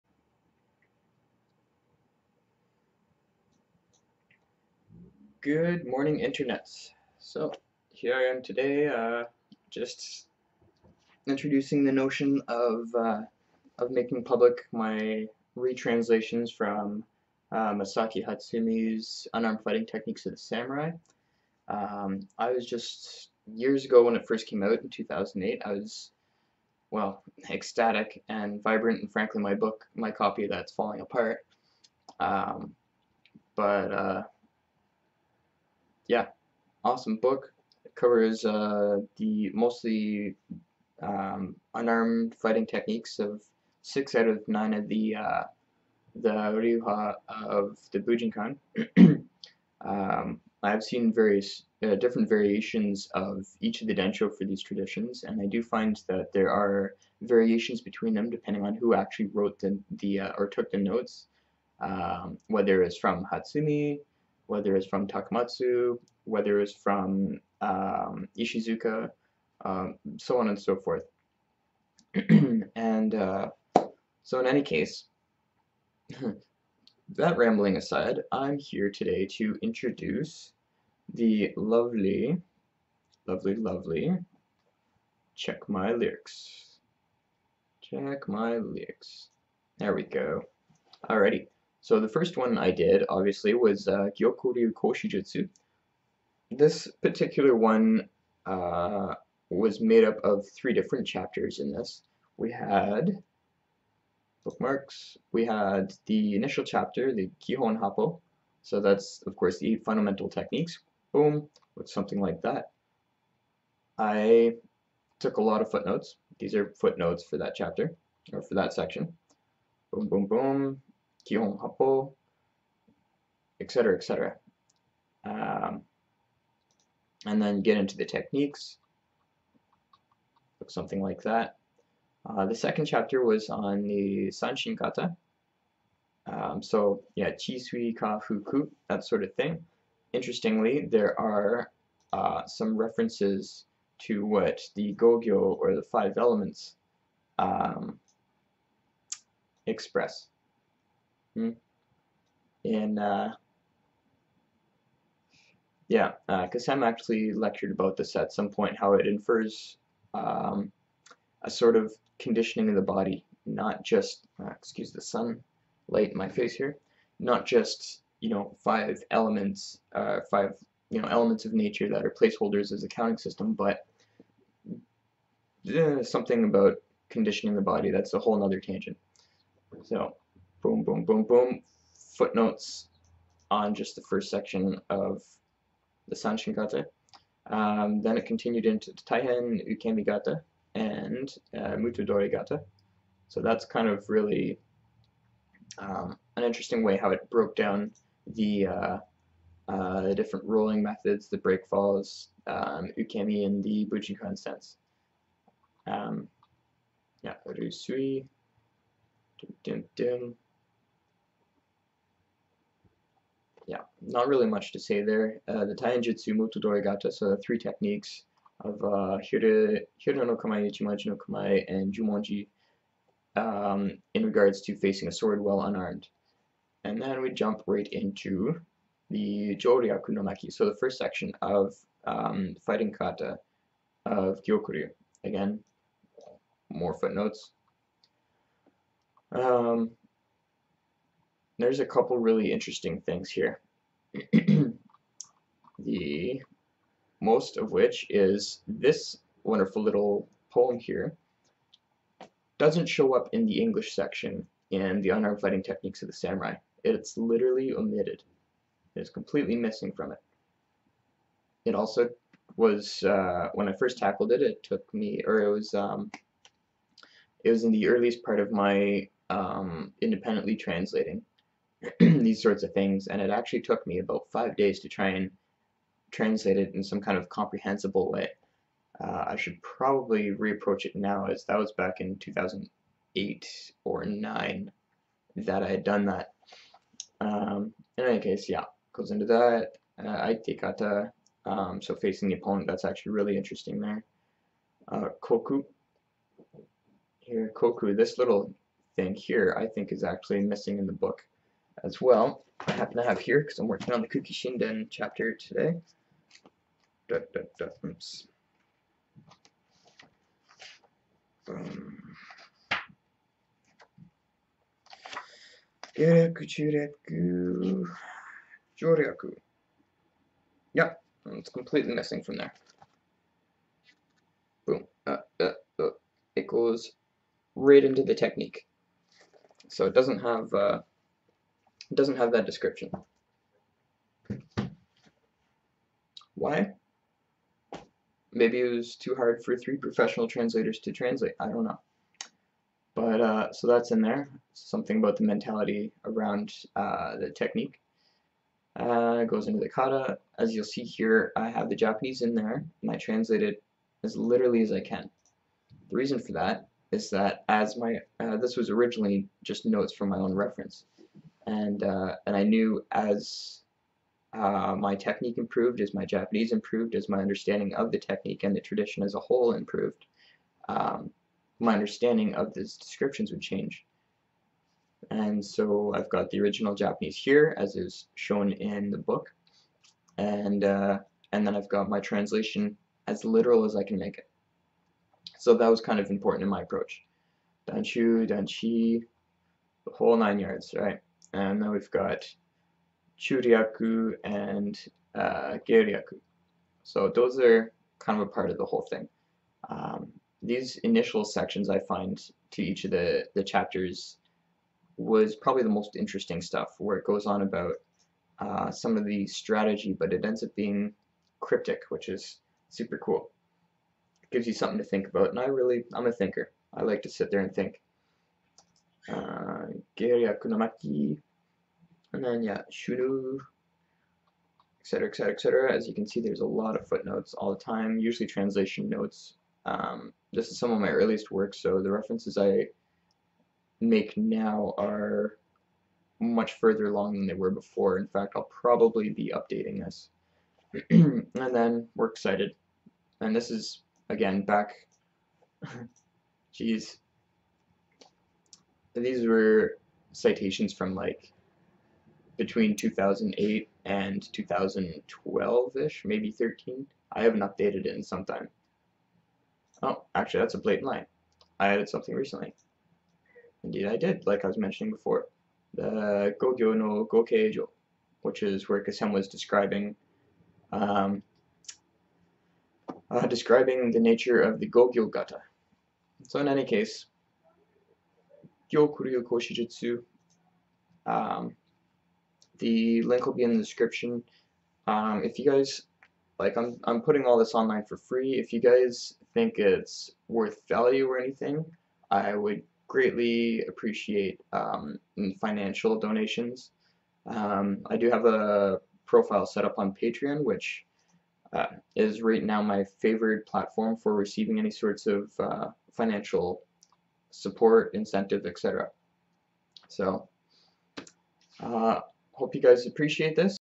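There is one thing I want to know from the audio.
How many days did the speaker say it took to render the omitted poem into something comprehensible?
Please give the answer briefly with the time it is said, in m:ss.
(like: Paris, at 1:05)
5, at 4:34.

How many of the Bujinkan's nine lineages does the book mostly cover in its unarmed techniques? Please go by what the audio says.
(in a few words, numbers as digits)
6.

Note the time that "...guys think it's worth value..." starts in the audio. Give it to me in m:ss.
8:08.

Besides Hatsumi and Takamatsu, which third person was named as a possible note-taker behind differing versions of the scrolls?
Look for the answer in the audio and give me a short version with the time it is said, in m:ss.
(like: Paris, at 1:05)
Ishizuka, at 1:08.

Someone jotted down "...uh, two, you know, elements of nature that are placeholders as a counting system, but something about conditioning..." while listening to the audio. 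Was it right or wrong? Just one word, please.
wrong.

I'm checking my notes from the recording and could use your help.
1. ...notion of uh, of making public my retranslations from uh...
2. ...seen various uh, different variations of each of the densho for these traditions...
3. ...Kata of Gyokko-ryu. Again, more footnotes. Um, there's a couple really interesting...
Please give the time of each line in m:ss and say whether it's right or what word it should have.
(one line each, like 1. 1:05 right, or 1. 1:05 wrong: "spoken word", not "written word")
1. 0:11 right
2. 0:50 right
3. 3:52 right.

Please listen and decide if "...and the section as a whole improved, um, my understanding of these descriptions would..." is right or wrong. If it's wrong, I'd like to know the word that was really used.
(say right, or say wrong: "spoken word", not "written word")
wrong: "tradition", not "section".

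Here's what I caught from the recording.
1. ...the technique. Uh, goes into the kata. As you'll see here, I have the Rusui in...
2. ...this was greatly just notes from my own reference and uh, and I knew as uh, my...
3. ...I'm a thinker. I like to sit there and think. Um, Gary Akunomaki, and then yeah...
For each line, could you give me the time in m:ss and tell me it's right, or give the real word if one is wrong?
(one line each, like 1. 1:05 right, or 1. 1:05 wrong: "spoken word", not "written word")
1. 5:47 wrong: "Japanese", not "Rusui"
2. 5:58 wrong: "originally", not "greatly"
3. 6:55 right.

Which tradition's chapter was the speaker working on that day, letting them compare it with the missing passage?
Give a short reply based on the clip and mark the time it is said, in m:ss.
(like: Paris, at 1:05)
Kuki Shinden, at 5:04.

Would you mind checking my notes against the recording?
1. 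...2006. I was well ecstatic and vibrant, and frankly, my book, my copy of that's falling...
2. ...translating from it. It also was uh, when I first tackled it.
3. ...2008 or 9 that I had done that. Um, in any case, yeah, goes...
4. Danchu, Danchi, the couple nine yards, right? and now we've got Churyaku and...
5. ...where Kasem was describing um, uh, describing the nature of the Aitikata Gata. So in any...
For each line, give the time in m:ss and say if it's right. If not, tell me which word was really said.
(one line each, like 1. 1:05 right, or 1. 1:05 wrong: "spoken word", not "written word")
1. 0:24 wrong: "2008", not "2006"
2. 4:19 wrong: "missing", not "translating"
3. 4:42 right
4. 6:27 wrong: "whole", not "couple"
5. 7:48 wrong: "Gogyo", not "Aitikata".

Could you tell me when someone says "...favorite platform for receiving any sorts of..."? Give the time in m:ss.
8:23.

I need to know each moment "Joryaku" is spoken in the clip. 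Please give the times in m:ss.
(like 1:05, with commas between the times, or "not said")
3:49, 5:18.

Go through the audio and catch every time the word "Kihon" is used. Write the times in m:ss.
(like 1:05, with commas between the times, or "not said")
1:47.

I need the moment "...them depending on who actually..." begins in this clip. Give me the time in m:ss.
0:58.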